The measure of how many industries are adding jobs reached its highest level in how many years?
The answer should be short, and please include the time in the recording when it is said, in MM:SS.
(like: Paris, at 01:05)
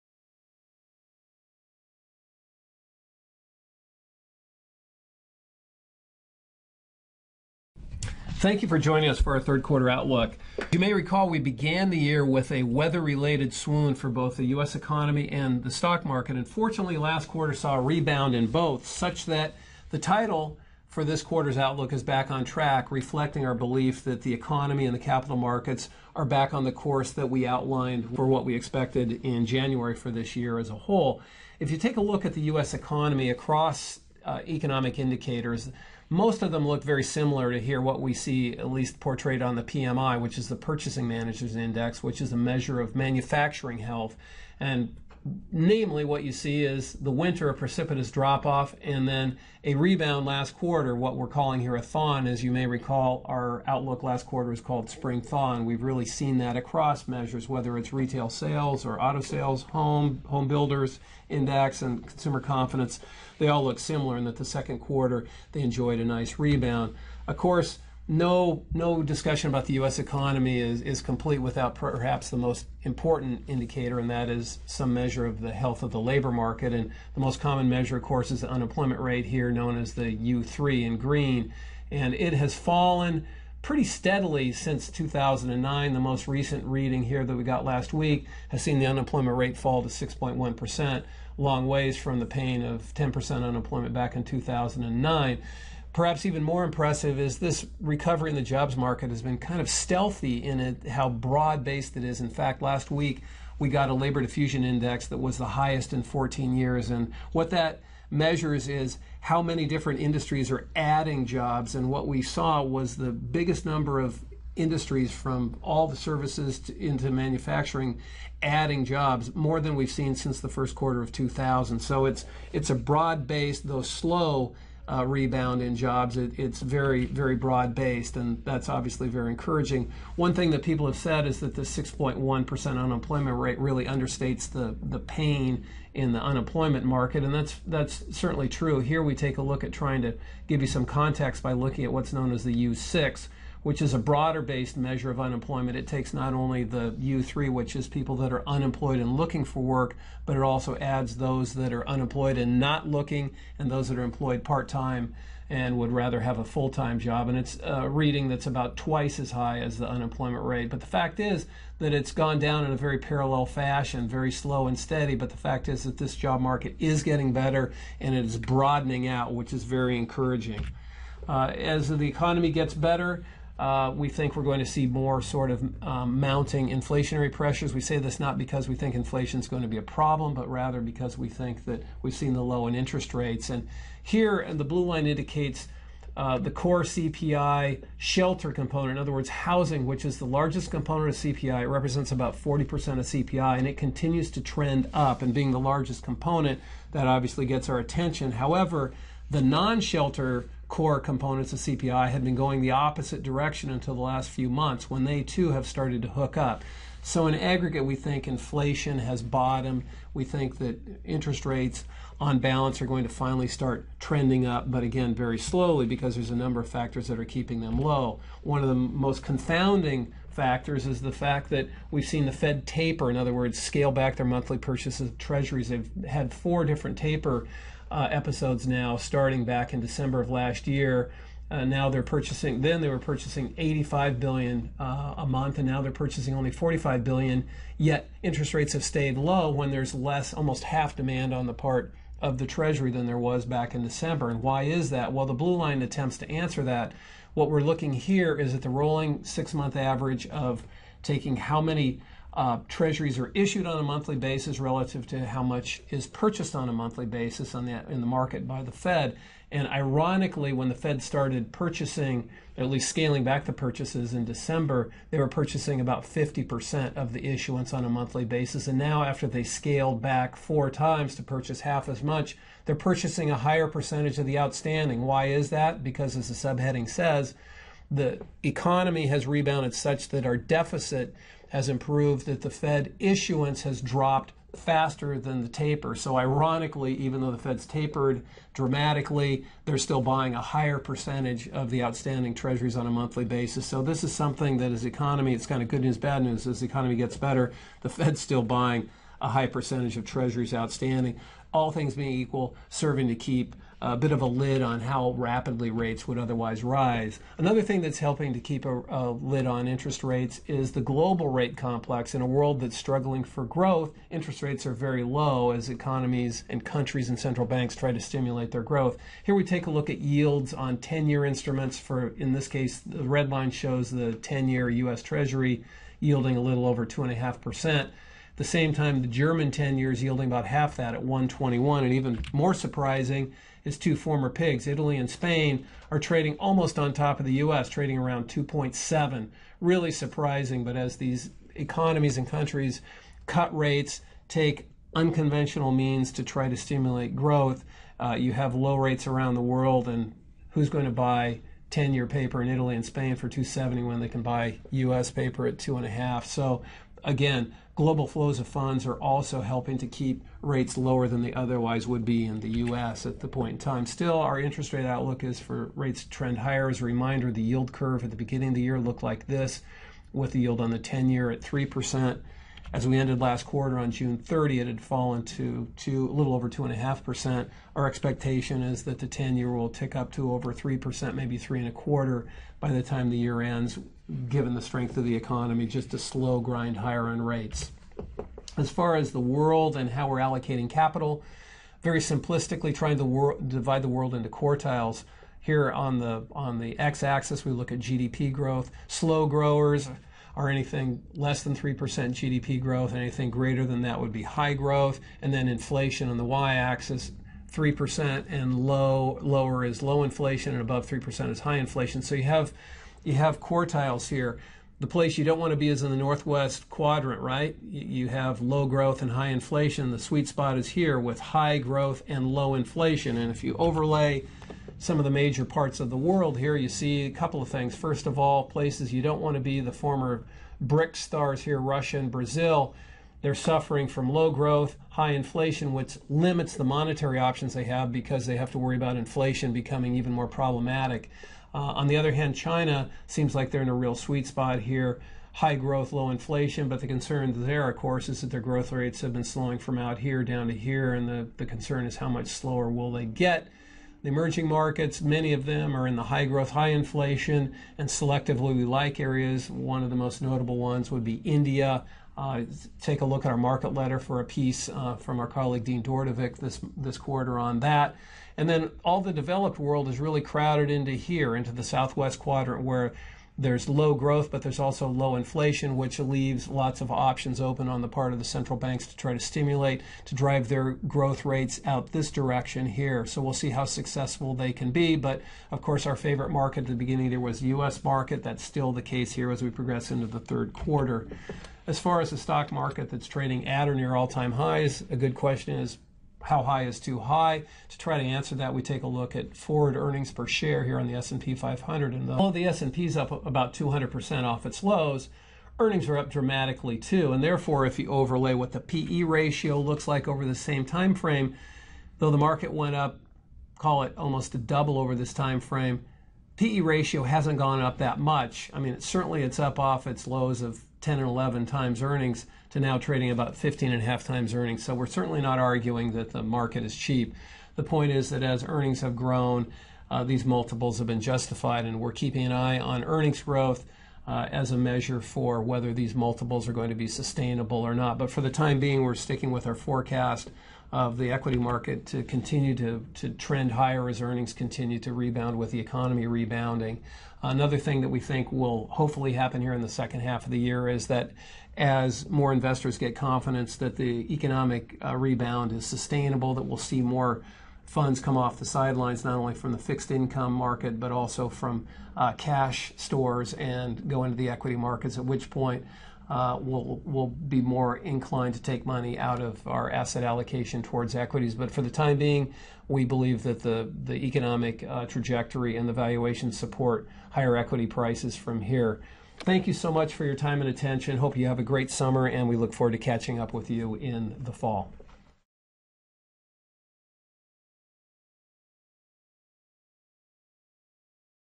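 14 years, at 01:46.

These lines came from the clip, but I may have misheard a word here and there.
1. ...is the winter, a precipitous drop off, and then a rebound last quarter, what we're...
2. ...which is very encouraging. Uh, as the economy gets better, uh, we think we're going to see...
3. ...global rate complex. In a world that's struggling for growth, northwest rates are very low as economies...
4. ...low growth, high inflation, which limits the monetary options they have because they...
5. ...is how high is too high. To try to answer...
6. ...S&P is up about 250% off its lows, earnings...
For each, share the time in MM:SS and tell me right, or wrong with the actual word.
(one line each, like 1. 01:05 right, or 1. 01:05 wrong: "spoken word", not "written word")
1. 00:46 right
2. 02:49 right
3. 05:10 wrong: "interest", not "northwest"
4. 07:14 right
5. 08:15 right
6. 08:22 wrong: "200", not "250".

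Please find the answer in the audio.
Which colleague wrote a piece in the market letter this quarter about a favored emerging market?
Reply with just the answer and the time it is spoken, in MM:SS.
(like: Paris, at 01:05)
Dean Dordevic, at 07:45.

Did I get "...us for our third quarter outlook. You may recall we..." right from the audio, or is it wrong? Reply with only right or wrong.
right.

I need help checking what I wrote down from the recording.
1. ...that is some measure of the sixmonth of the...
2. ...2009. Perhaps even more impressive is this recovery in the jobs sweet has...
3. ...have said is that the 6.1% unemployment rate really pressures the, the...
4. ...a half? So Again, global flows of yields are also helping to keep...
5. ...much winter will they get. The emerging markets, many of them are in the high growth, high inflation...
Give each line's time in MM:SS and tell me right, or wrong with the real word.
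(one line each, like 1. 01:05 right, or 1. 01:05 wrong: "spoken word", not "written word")
1. 01:14 wrong: "health", not "sixmonth"
2. 01:34 wrong: "market", not "sweet"
3. 02:10 wrong: "understates", not "pressures"
4. 05:55 wrong: "funds", not "yields"
5. 07:32 wrong: "slower", not "winter".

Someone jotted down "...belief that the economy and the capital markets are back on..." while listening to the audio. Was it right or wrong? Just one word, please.
right.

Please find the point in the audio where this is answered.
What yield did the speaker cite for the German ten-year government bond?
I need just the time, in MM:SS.
05:31.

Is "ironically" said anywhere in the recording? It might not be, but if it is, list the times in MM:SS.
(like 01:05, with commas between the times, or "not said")
04:19, 04:46.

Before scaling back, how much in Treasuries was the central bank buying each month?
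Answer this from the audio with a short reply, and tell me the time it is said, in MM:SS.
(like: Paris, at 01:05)
85 billion, at 03:53.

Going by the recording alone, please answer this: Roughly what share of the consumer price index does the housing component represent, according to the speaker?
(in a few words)
40%.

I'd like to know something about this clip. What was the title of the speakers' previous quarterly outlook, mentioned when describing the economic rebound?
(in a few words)
Spring thaw.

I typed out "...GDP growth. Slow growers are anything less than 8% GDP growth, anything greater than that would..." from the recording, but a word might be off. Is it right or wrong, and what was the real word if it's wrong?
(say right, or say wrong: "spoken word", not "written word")
wrong: "3", not "8".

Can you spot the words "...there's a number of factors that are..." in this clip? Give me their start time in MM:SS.
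03:36.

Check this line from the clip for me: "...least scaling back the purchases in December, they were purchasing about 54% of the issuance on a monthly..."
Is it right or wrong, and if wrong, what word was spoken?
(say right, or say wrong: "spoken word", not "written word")
wrong: "50", not "54".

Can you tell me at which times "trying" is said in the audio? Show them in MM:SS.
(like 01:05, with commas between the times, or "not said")
02:19, 06:32.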